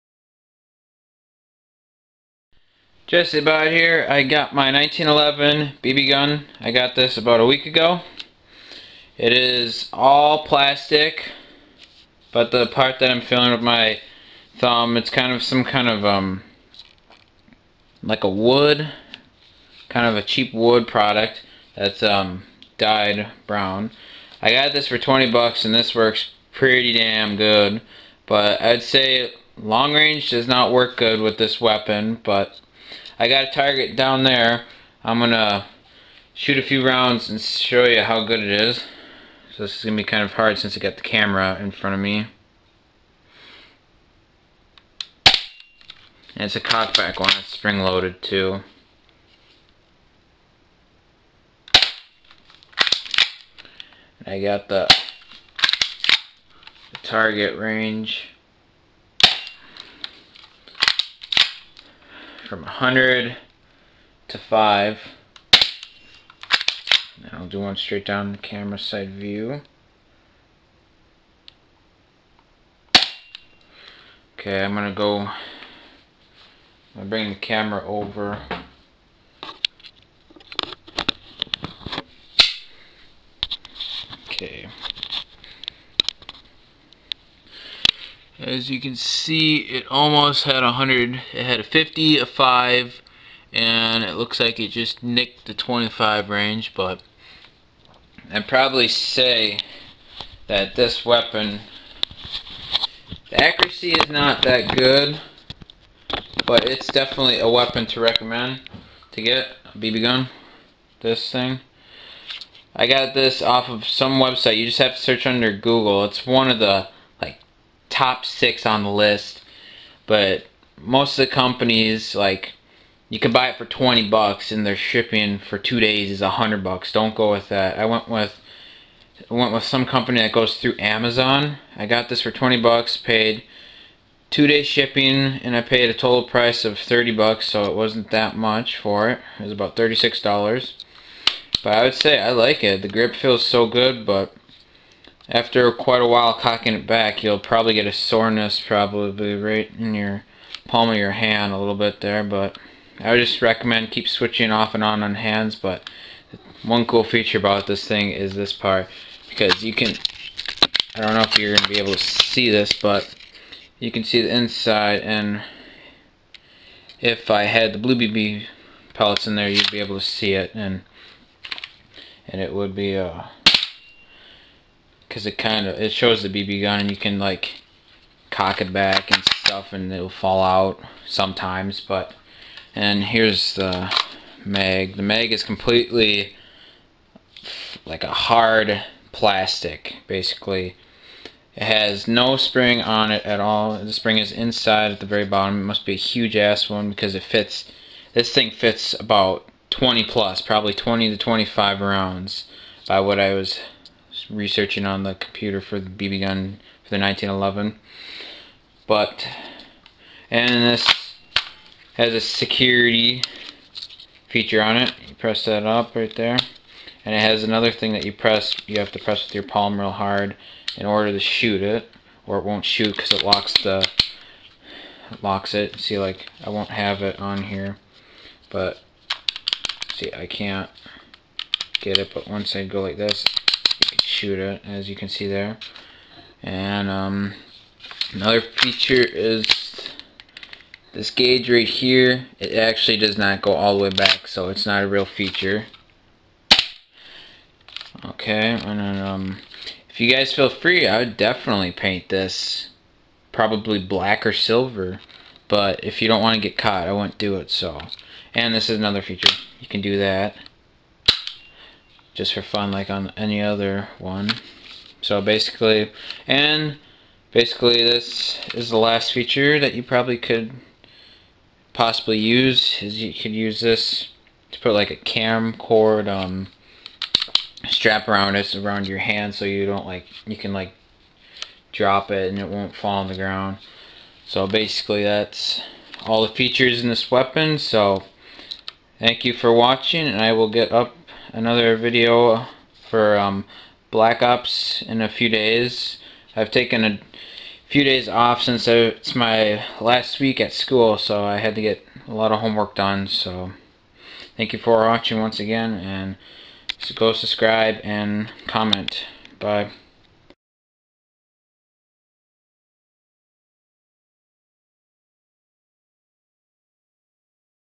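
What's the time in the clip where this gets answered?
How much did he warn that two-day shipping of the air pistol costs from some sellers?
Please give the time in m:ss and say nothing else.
2:06.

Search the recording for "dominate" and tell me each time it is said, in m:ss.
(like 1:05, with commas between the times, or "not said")
not said.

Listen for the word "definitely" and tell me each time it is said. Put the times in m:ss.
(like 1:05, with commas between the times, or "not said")
1:46, 4:11.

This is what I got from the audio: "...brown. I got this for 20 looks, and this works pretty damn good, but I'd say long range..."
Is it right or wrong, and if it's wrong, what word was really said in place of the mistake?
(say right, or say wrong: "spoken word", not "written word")
wrong: "bucks", not "looks".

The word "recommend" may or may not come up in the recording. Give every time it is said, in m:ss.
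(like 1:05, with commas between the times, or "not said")
1:47, 2:33.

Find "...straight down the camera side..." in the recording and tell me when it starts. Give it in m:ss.
1:07.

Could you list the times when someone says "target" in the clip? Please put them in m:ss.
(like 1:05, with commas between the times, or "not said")
0:33, 0:57.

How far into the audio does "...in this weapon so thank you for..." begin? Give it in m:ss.
4:46.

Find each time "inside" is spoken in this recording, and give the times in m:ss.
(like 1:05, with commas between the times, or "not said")
2:44, 3:14.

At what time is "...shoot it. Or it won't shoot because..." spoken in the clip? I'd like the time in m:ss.
3:41.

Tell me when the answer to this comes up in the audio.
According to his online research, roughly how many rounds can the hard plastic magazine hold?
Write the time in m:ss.
3:20.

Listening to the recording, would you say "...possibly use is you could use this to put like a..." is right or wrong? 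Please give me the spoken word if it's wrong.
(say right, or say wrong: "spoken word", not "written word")
right.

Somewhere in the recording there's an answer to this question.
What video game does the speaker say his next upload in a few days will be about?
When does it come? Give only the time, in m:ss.
4:53.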